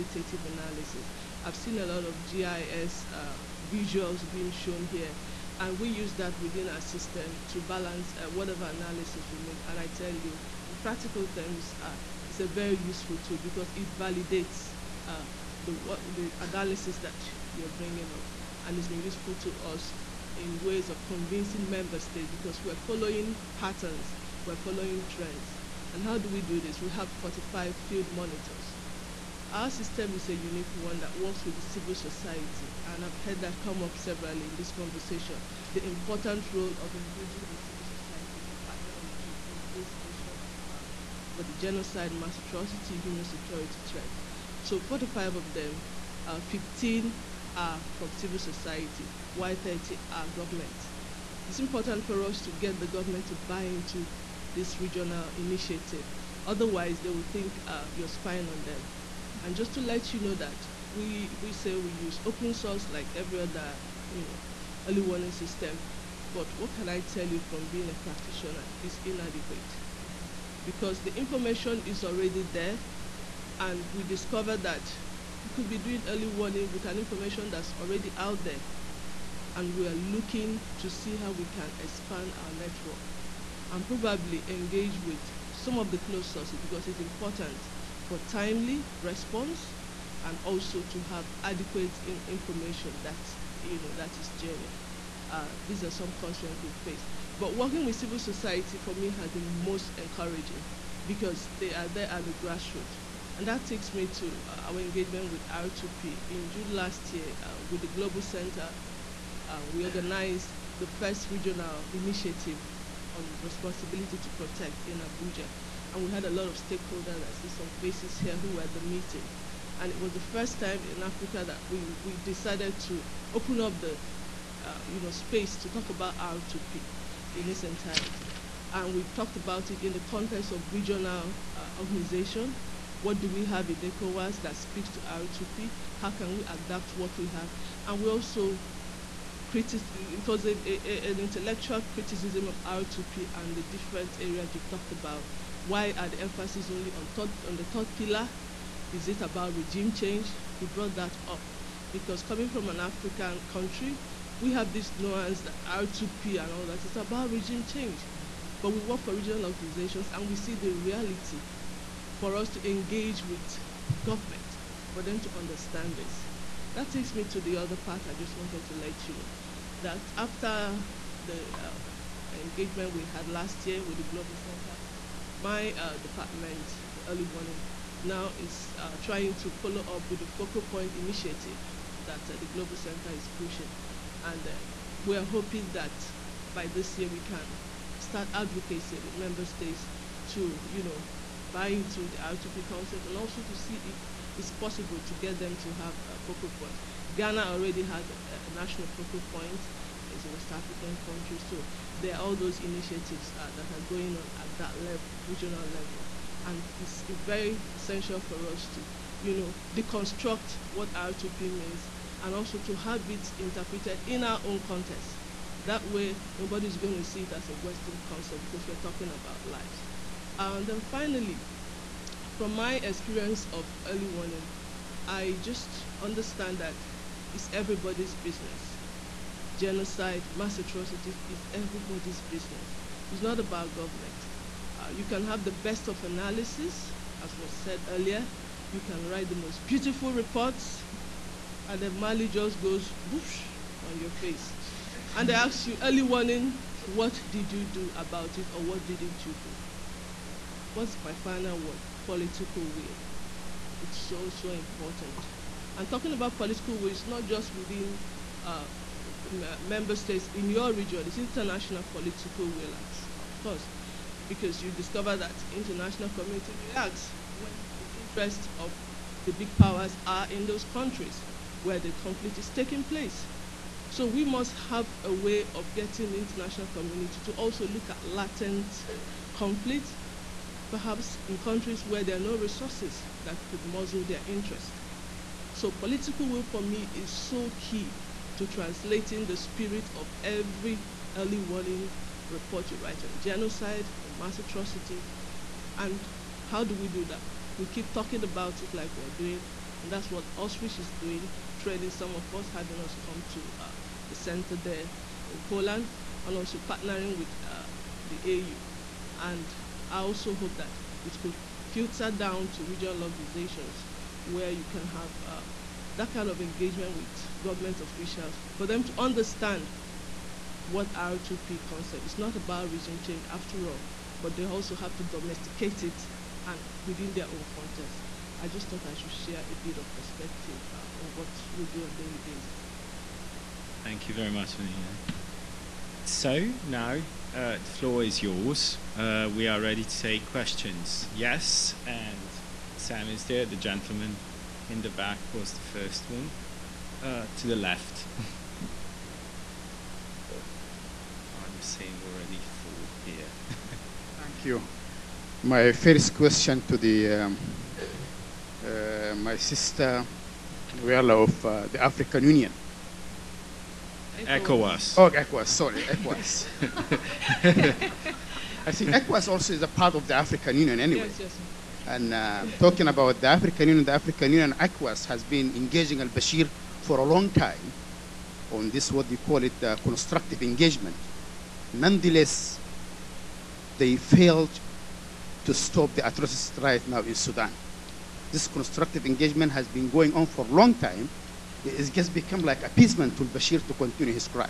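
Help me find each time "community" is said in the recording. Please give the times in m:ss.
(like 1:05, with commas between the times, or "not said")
4:26, 4:36.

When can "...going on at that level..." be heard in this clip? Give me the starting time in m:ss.
3:23.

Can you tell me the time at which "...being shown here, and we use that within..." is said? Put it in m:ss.
0:04.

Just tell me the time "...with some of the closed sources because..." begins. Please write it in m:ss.
1:25.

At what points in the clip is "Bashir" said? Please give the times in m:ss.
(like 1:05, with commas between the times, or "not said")
6:16, 6:33.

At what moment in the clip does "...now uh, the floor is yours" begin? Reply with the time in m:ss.
5:36.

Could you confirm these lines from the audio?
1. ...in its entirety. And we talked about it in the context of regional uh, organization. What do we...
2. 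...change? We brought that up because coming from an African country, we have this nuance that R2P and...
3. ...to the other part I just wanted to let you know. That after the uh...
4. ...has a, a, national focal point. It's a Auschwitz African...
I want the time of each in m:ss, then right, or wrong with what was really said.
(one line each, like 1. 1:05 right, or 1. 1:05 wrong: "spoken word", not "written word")
1. 2:07 right
2. 2:29 right
3. 2:47 right
4. 3:17 wrong: "West", not "Auschwitz".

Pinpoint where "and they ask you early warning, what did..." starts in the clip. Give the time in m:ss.
4:05.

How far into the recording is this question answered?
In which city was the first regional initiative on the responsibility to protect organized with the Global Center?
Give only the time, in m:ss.
1:55.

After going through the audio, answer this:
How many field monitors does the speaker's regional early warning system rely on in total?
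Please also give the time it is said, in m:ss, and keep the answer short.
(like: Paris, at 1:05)
45, at 0:27.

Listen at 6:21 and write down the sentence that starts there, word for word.
Nonetheless, they failed to stop the atrocities right now in Sudan.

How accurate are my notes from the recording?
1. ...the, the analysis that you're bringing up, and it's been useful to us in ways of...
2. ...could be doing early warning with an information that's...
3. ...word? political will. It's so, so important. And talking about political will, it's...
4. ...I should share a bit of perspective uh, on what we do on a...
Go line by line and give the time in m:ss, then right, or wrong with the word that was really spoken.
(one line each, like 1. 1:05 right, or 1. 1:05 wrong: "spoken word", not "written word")
1. 0:15 right
2. 1:15 right
3. 4:11 right
4. 5:28 right.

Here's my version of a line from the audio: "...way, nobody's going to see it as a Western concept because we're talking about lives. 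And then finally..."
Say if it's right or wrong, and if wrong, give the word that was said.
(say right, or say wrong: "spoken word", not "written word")
right.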